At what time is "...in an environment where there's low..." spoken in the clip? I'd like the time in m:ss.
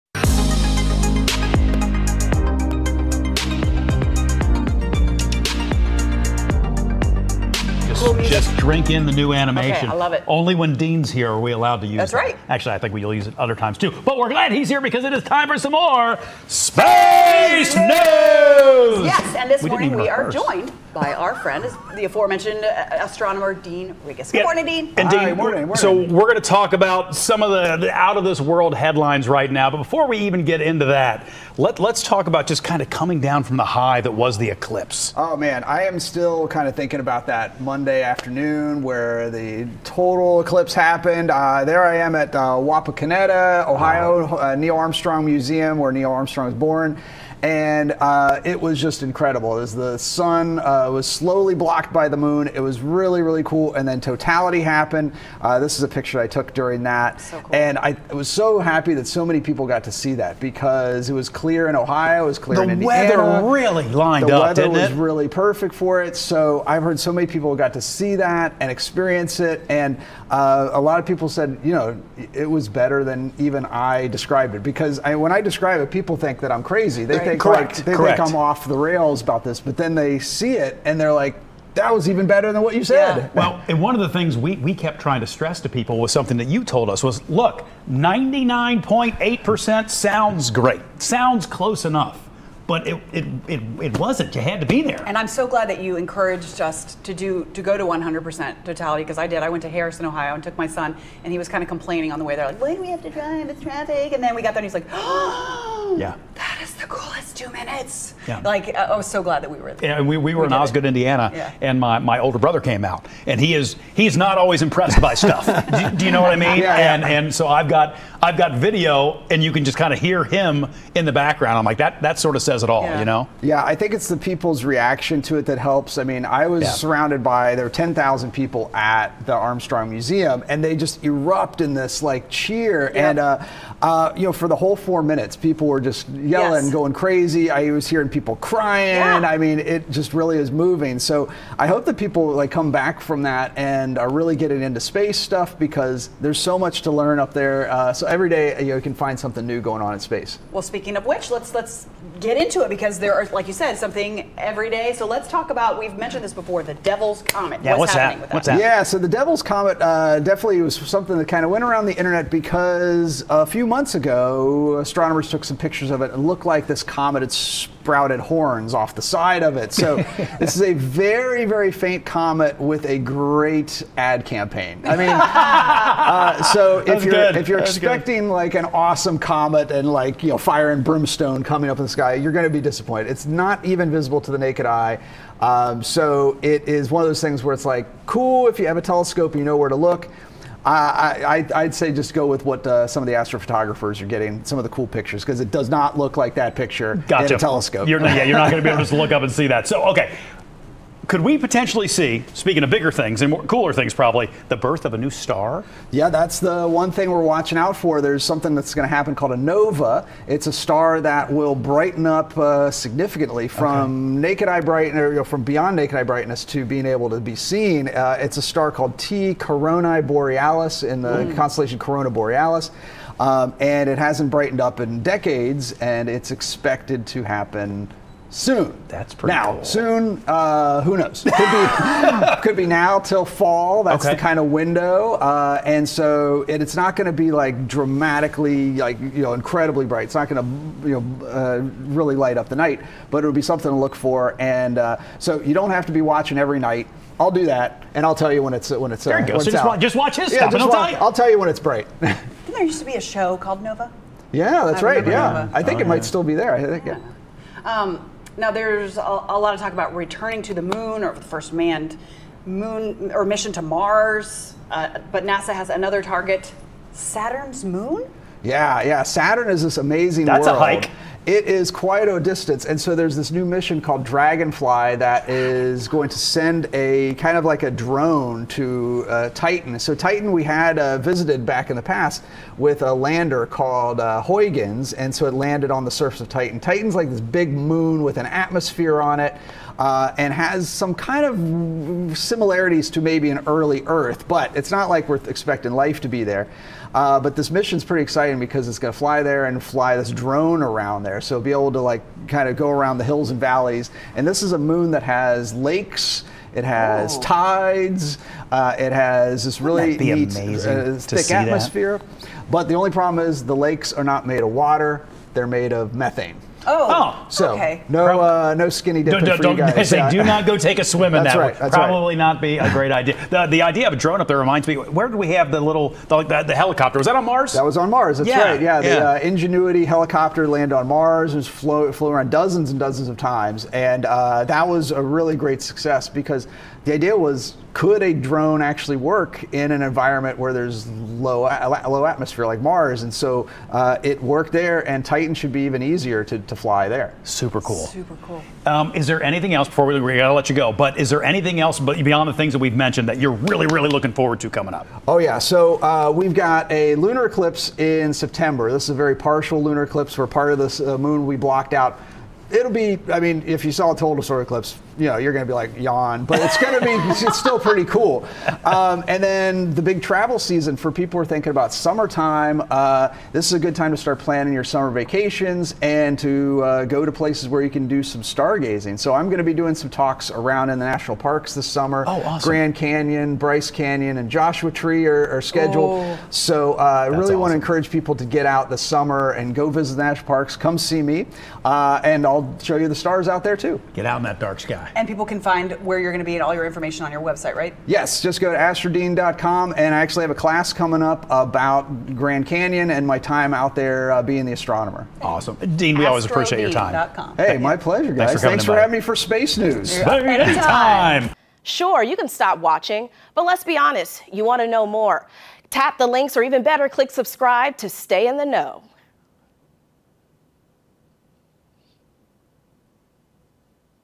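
5:39.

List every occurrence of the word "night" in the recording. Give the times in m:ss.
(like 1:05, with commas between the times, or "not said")
4:02, 4:06.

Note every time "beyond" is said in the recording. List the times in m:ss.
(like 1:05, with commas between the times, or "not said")
3:35, 5:52.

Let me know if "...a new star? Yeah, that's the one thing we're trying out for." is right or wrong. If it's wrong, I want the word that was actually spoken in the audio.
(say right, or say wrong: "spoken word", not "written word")
wrong: "watching", not "trying".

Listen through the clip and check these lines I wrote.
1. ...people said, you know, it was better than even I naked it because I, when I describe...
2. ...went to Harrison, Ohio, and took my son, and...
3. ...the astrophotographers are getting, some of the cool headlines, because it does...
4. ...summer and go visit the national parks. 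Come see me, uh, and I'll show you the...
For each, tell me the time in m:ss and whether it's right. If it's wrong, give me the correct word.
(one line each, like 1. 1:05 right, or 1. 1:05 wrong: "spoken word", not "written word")
1. 1:11 wrong: "described", not "naked"
2. 1:39 right
3. 3:13 wrong: "pictures", not "headlines"
4. 6:28 right.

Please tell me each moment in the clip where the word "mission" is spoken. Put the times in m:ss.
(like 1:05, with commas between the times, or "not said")
4:23, 4:33, 4:57.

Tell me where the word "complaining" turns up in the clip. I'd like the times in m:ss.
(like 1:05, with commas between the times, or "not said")
1:41.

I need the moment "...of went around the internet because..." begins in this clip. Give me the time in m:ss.
2:41.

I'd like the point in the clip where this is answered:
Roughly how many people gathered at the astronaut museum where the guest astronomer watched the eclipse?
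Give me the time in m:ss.
2:07.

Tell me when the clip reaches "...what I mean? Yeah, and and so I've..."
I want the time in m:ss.
1:56.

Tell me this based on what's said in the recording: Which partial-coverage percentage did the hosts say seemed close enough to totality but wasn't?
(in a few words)
99.8%.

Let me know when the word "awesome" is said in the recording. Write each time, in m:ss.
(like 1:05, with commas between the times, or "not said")
2:58, 6:22, 6:27, 6:45.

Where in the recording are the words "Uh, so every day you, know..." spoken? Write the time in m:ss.
2:27.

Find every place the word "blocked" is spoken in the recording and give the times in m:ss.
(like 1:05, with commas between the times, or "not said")
0:51, 6:01.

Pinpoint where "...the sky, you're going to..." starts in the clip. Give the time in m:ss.
3:01.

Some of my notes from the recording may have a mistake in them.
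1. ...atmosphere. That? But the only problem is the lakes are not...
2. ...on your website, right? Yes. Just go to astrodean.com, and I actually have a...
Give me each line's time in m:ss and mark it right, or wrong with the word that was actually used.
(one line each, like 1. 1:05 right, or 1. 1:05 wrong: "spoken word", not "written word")
1. 5:11 right
2. 6:37 right.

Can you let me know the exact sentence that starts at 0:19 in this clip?
and this we morning we are joined by our friend, the aforementioned uh, astronomer Dean Regas.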